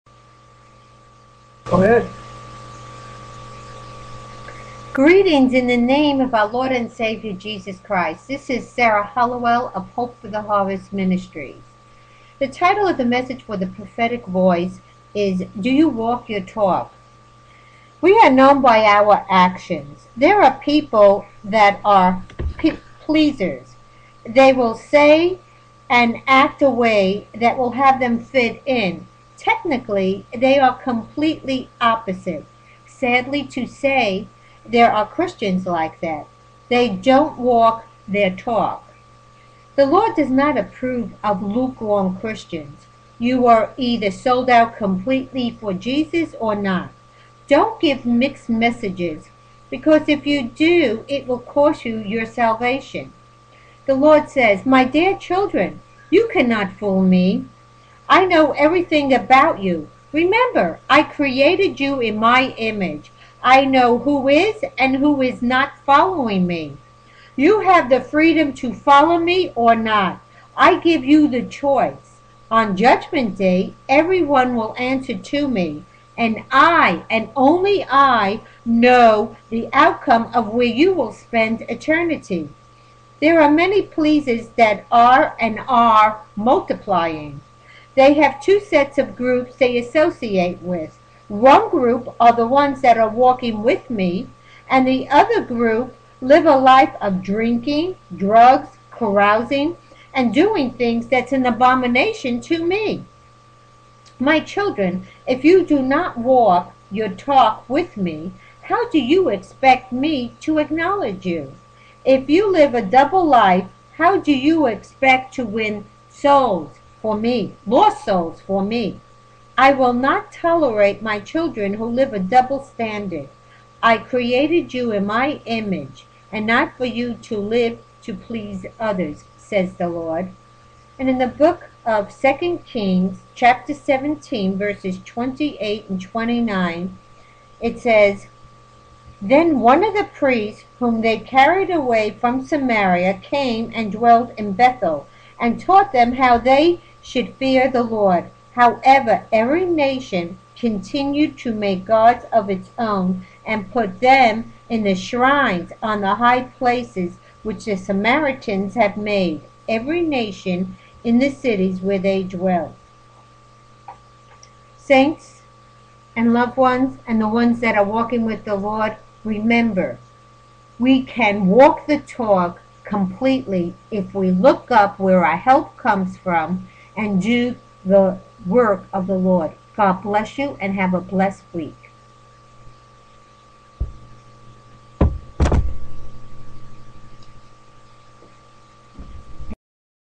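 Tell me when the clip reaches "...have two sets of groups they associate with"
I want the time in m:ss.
1:28.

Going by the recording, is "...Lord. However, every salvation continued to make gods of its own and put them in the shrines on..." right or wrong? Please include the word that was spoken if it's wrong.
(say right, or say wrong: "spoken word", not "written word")
wrong: "nation", not "salvation".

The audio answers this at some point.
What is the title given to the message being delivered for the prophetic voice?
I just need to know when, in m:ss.
0:15.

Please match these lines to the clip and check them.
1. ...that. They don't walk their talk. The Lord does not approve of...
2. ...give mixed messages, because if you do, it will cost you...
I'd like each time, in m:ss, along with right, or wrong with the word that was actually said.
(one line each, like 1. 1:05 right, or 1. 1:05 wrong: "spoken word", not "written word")
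1. 0:36 right
2. 0:47 right.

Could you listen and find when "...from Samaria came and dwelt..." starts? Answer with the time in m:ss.
2:22.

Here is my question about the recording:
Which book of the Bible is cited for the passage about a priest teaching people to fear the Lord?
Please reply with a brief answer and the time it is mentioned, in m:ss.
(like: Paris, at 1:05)
Second Kings, at 2:12.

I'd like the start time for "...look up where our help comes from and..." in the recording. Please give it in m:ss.
2:54.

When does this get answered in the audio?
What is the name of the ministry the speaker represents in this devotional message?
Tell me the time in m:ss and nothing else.
0:09.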